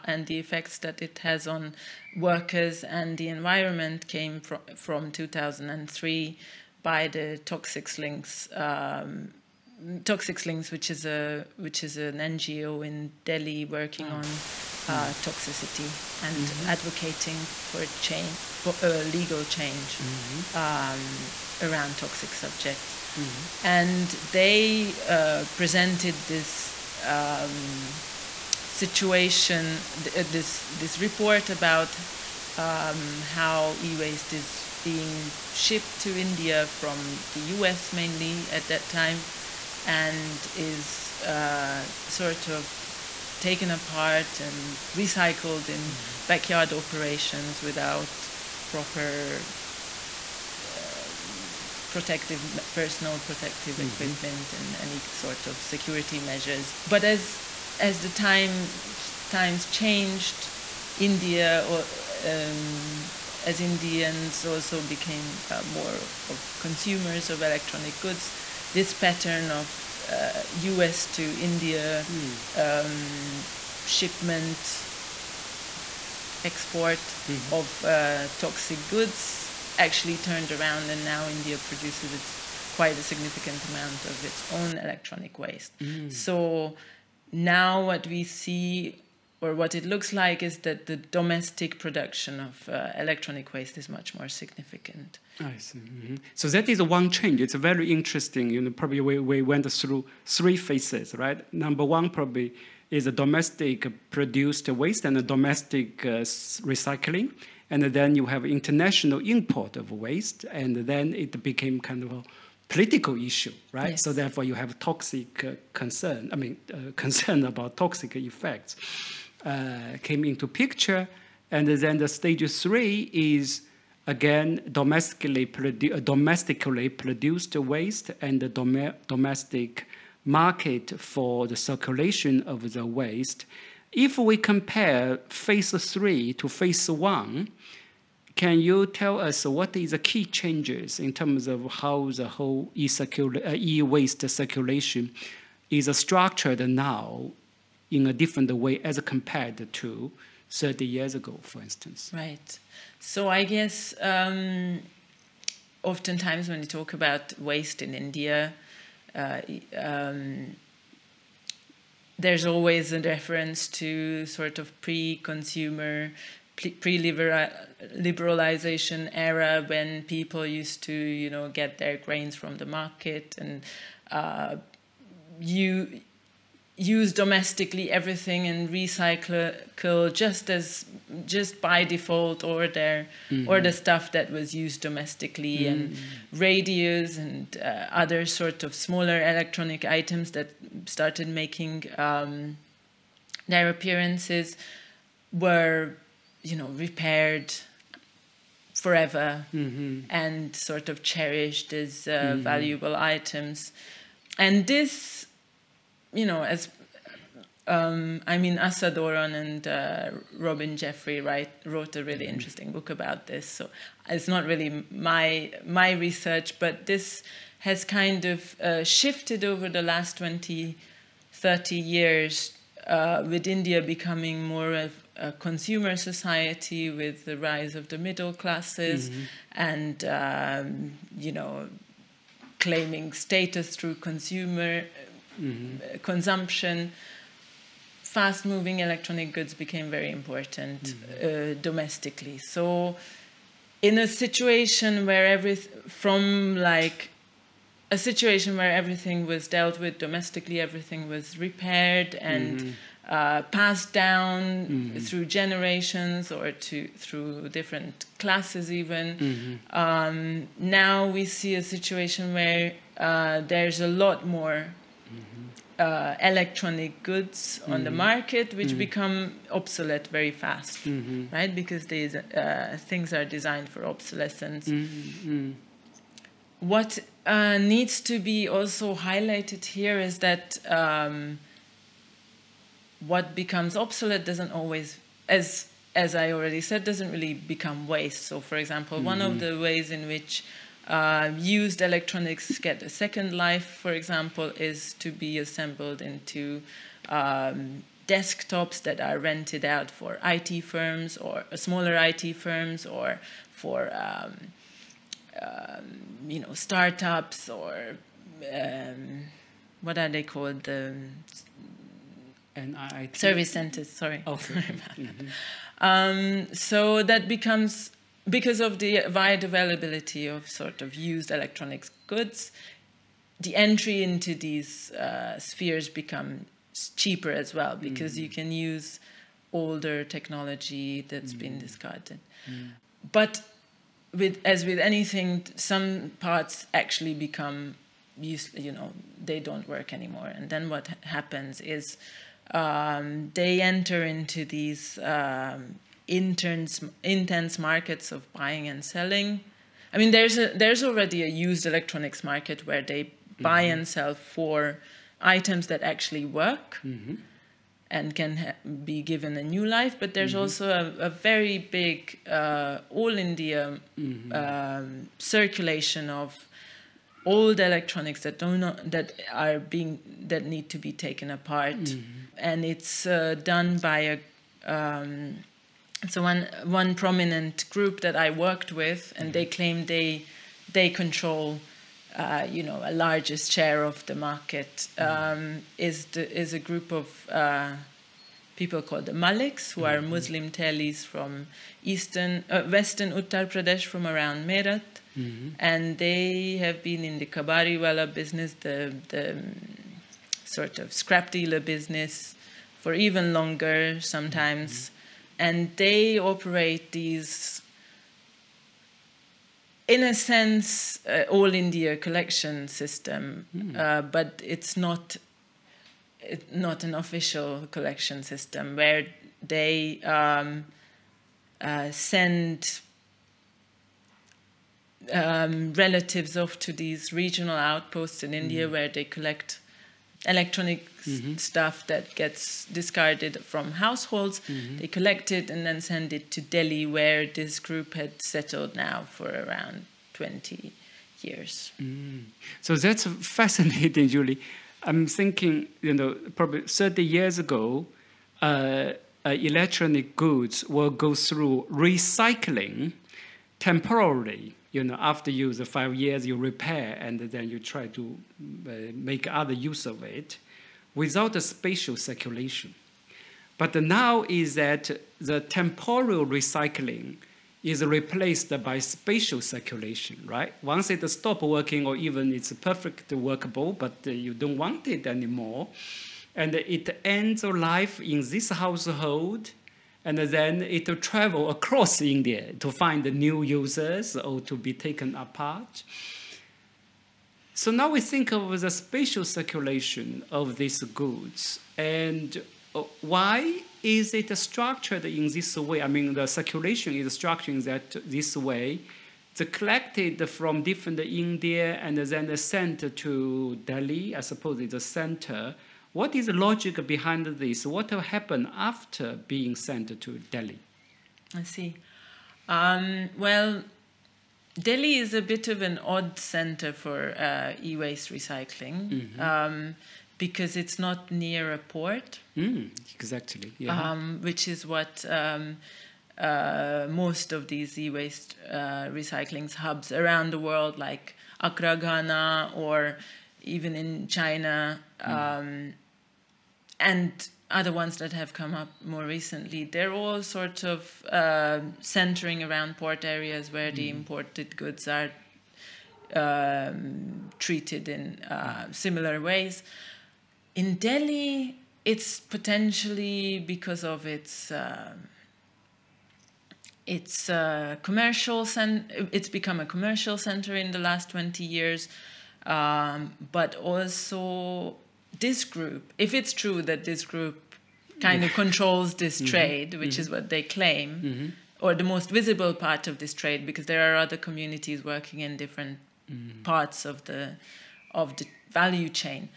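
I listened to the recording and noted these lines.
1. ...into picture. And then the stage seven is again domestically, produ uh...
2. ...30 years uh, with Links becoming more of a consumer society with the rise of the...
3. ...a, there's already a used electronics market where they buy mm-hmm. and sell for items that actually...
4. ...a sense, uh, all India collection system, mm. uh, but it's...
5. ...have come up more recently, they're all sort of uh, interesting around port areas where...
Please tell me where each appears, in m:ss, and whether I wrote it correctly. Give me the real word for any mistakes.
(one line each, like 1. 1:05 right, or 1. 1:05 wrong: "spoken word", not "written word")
1. 2:00 wrong: "three", not "seven"
2. 3:41 wrong: "India", not "Links"
3. 5:50 right
4. 6:50 right
5. 8:58 wrong: "centering", not "interesting".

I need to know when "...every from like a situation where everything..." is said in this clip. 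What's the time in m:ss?
4:05.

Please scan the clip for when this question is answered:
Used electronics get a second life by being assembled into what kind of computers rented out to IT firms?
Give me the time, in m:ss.
4:58.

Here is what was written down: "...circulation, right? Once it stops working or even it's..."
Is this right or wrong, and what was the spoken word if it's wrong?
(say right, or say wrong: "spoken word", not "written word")
right.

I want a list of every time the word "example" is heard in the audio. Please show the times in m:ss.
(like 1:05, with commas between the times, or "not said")
4:48, 4:53.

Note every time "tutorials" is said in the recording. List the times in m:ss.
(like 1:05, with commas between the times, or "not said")
not said.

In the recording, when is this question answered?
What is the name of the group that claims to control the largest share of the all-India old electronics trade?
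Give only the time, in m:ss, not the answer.
6:29.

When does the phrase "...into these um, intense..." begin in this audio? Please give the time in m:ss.
5:44.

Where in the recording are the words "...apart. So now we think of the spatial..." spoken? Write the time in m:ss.
8:05.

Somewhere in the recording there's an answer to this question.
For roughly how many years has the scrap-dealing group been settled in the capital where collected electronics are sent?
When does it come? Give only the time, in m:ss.
7:19.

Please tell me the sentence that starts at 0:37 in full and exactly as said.
mainly at that time, and is uh, sort of taken apart and recycled in mm.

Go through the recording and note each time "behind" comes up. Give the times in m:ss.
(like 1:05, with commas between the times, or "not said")
8:26.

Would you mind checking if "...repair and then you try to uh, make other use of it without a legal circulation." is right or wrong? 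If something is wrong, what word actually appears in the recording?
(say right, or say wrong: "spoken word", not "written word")
wrong: "spatial", not "legal".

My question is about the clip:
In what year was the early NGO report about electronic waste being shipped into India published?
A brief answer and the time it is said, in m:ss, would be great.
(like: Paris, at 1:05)
2003, at 0:05.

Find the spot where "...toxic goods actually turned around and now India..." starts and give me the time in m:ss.
1:18.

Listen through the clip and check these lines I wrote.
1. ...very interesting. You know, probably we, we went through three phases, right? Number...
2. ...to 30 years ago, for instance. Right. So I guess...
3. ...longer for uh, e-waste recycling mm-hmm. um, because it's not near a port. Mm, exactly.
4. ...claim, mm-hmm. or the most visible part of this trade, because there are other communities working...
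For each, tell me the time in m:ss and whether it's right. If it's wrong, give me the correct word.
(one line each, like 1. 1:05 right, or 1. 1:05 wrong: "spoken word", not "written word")
1. 1:37 right
2. 2:29 right
3. 8:36 wrong: "center", not "longer"
4. 9:30 right.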